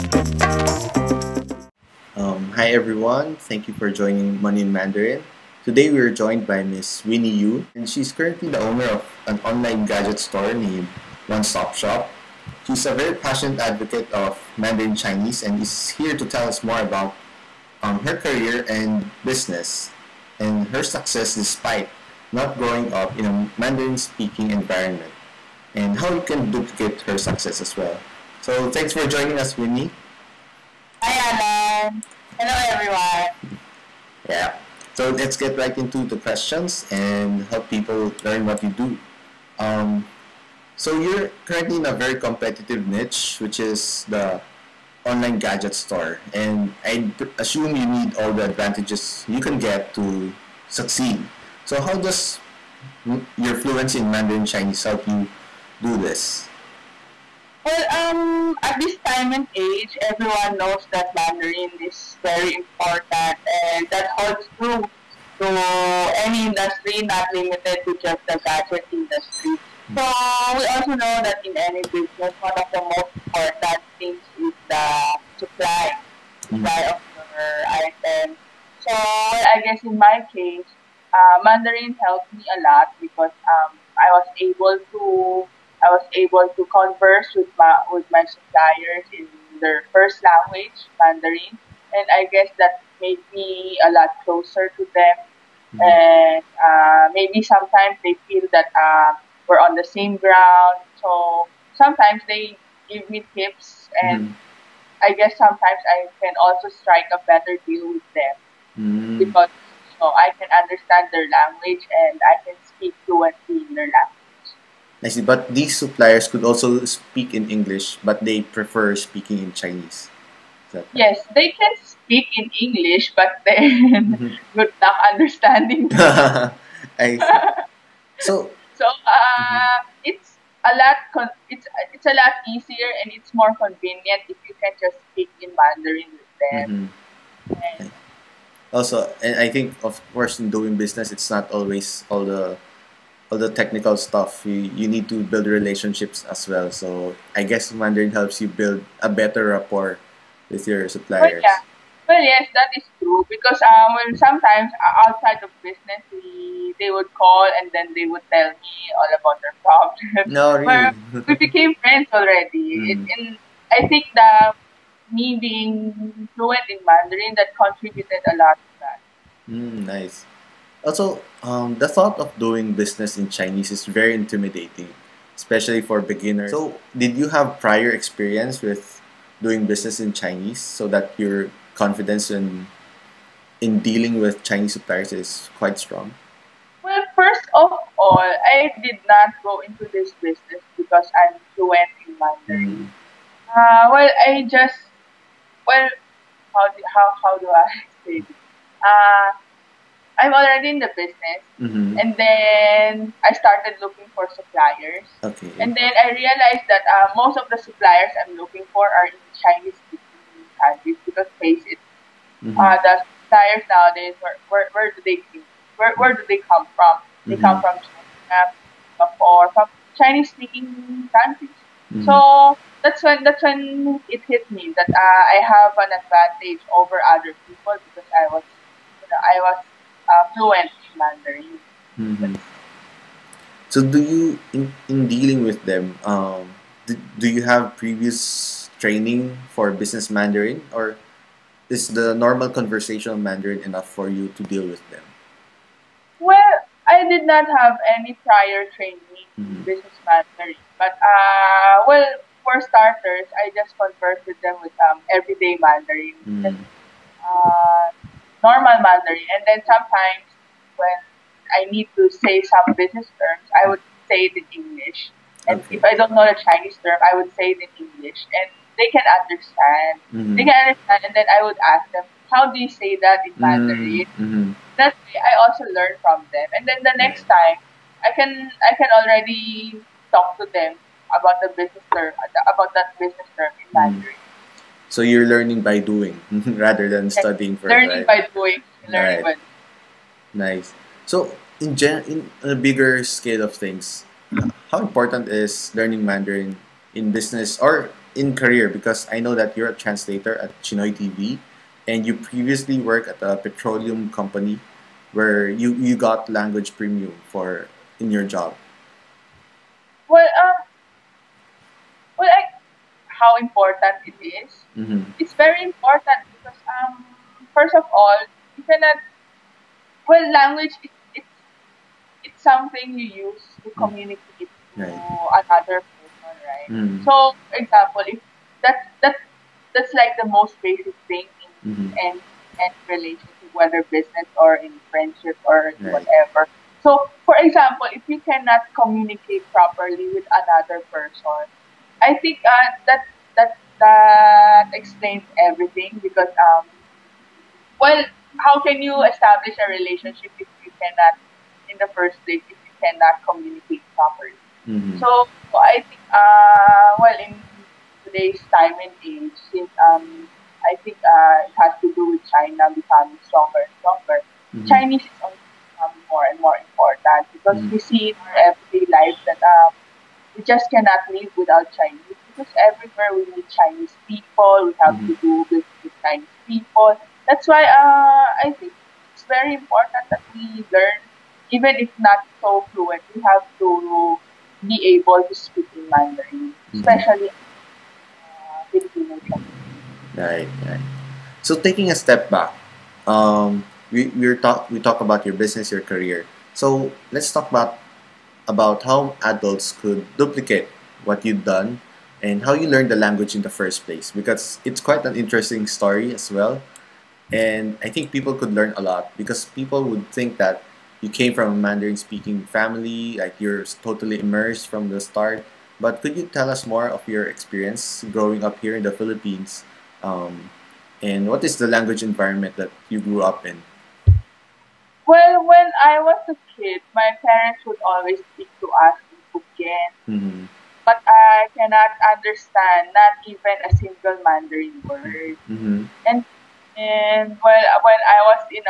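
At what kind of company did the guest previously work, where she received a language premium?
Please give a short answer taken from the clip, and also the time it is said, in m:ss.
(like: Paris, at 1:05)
A petroleum company, at 5:03.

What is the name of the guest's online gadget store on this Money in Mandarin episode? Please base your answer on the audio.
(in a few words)
One Stop Shop.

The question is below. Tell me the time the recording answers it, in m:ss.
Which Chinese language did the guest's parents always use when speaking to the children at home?
7:09.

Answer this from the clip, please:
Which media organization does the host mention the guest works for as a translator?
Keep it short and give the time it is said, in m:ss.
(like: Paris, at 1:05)
Chinoy TV, at 5:00.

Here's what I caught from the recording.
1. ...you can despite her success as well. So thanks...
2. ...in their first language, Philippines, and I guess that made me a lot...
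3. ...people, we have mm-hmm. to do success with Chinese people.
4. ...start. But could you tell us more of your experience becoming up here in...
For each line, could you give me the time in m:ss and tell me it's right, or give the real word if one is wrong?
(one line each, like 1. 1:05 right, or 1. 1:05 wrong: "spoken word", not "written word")
1. 0:26 wrong: "duplicate", not "despite"
2. 1:29 wrong: "Mandarin", not "Philippines"
3. 6:14 wrong: "business", not "success"
4. 6:55 wrong: "growing", not "becoming".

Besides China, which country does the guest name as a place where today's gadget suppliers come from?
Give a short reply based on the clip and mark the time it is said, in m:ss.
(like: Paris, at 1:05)
Singapore, at 3:38.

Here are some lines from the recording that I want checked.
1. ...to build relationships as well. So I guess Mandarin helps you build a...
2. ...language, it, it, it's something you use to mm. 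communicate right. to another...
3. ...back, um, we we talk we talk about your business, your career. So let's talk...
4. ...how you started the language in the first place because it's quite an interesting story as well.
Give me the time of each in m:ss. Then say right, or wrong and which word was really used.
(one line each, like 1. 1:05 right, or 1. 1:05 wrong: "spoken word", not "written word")
1. 2:25 right
2. 5:20 right
3. 6:32 right
4. 6:42 wrong: "learned", not "started".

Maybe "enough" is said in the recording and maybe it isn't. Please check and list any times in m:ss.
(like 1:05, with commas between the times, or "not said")
4:03.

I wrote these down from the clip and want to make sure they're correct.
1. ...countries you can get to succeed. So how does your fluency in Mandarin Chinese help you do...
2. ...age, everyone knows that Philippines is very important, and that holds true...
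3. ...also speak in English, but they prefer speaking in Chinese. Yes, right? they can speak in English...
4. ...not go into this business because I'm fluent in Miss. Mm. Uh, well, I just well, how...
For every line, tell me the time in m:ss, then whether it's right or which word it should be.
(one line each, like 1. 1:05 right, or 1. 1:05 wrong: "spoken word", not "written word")
1. 0:48 wrong: "advantages", not "countries"
2. 0:59 wrong: "Mandarin", not "Philippines"
3. 1:56 right
4. 3:09 wrong: "Mandarin", not "Miss".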